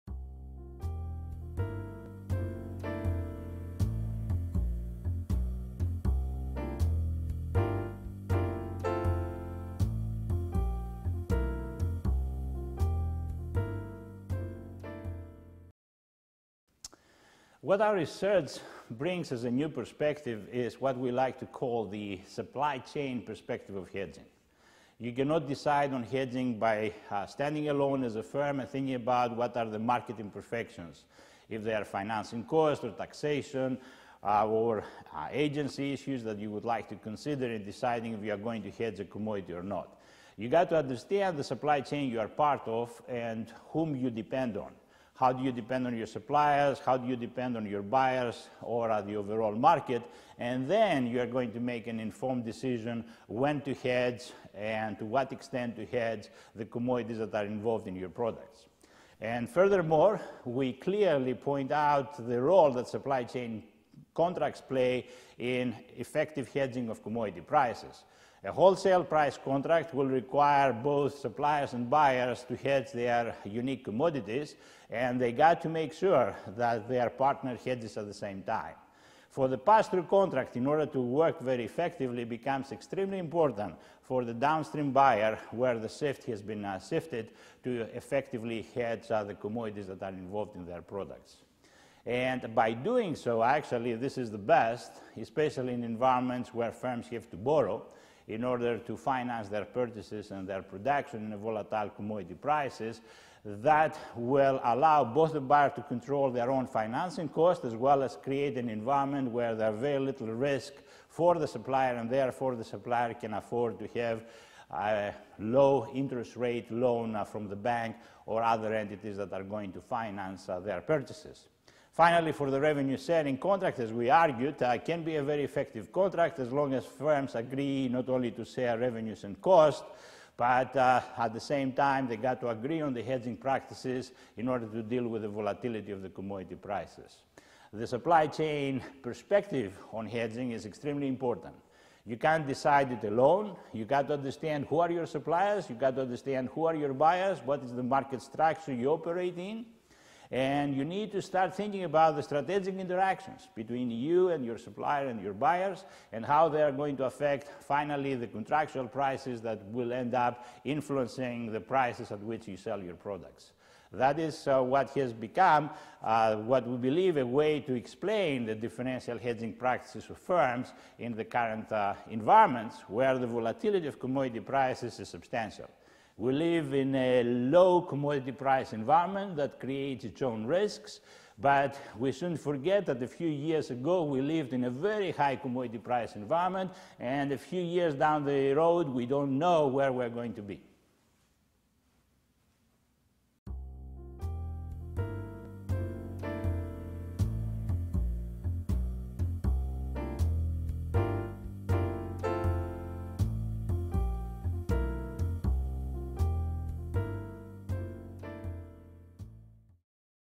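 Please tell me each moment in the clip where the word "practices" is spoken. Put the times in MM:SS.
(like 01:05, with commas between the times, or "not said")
02:13, 02:49.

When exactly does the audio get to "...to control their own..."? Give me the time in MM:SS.
01:45.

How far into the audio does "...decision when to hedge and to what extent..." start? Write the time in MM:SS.
00:52.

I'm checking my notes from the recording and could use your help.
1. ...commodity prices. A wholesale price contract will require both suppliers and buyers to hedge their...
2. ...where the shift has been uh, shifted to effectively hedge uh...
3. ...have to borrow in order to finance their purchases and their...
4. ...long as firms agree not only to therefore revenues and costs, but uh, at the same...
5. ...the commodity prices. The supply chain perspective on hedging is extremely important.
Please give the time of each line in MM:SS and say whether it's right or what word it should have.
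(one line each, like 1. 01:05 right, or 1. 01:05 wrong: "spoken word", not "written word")
1. 01:07 right
2. 01:25 right
3. 01:37 right
4. 02:06 wrong: "share", not "therefore"
5. 02:16 right.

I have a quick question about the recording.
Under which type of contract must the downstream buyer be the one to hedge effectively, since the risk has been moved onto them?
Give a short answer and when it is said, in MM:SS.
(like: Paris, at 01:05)
pass-through contract, at 01:19.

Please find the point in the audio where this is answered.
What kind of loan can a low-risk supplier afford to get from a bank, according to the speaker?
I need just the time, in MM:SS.
01:55.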